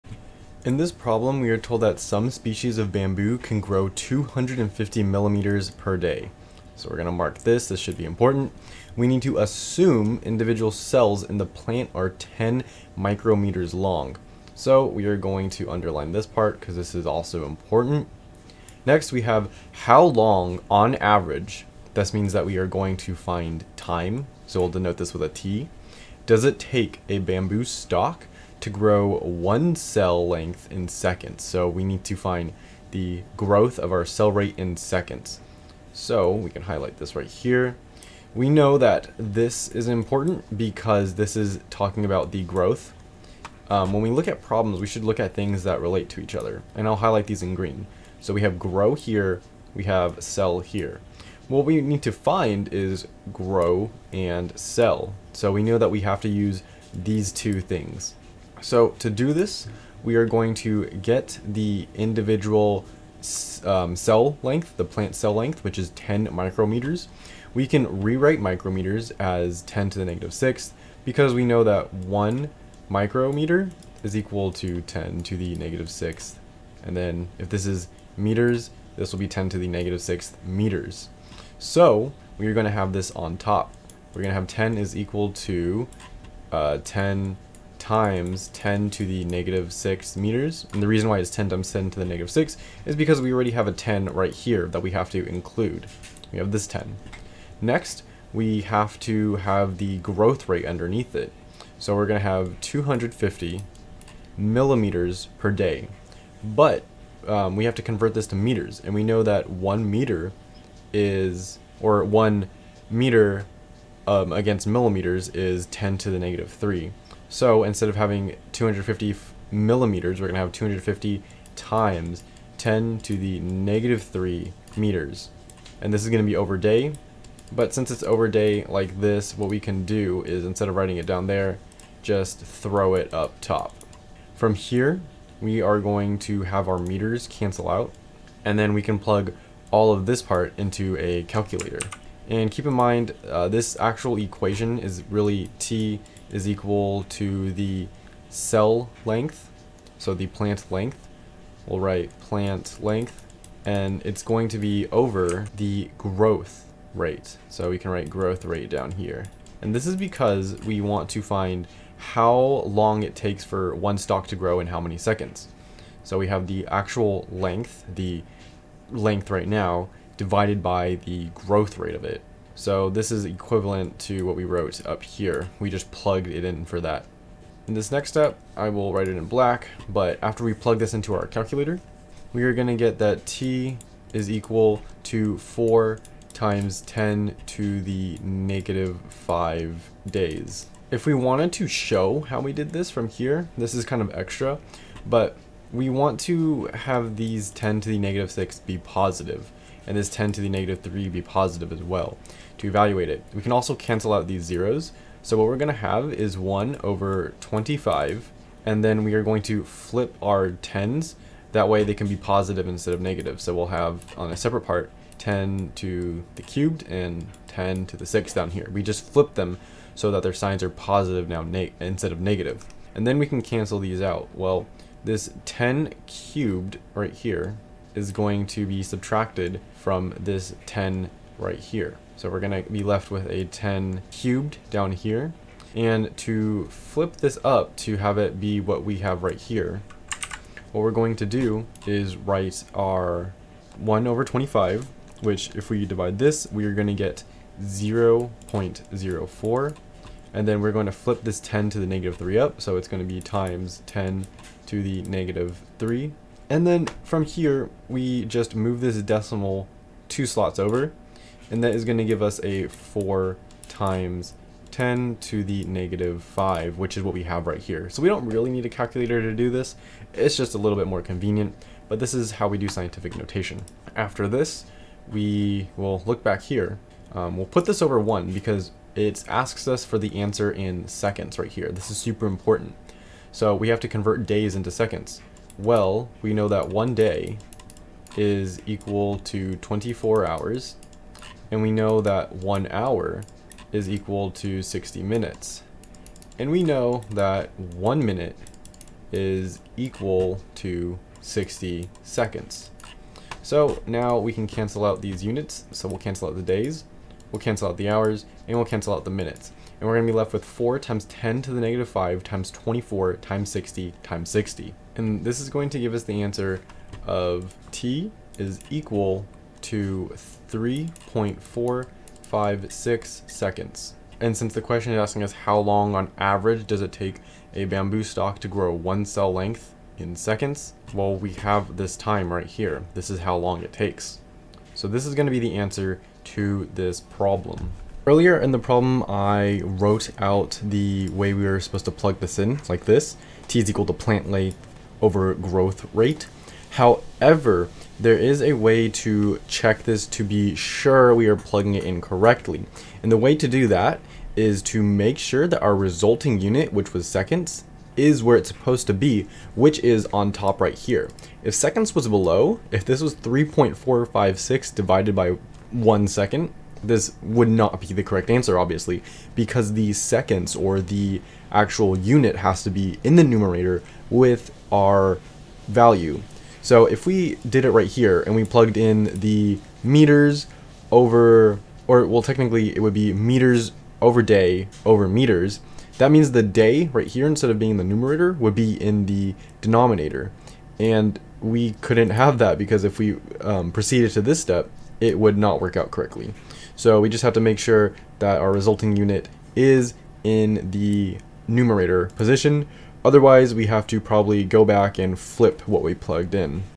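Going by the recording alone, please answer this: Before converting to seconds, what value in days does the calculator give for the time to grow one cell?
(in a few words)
4 times 10 to the negative 5 days.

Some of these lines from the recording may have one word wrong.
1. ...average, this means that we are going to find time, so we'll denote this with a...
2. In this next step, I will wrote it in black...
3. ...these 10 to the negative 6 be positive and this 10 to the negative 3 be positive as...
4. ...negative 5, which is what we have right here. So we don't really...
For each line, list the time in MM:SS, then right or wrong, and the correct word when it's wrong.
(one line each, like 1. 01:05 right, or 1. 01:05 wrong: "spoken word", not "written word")
1. 00:20 right
2. 02:57 wrong: "write", not "wrote"
3. 03:17 right
4. 04:25 right.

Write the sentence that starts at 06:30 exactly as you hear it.
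And we couldn't have that because if we um, proceeded to this step, it would not work out correctly.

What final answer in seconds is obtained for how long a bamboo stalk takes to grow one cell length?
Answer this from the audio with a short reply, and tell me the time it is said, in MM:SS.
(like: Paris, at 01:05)
3.456 seconds, at 05:20.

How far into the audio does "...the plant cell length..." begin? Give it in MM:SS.
01:04.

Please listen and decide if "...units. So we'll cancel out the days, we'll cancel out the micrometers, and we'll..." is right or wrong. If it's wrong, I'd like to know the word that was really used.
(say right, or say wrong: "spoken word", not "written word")
wrong: "hours", not "micrometers".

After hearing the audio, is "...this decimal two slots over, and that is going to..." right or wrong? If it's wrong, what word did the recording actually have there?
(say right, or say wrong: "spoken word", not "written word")
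right.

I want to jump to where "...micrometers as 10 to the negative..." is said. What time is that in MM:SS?
01:08.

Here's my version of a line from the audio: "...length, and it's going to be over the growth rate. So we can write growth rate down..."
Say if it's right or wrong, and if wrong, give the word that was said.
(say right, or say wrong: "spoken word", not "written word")
right.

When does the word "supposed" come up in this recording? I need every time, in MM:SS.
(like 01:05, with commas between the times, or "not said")
05:41, 05:58.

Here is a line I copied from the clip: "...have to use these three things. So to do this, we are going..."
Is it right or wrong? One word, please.
wrong.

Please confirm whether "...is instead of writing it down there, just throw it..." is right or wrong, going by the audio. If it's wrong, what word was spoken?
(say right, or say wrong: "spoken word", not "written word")
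right.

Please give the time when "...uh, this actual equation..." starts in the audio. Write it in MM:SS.
02:23.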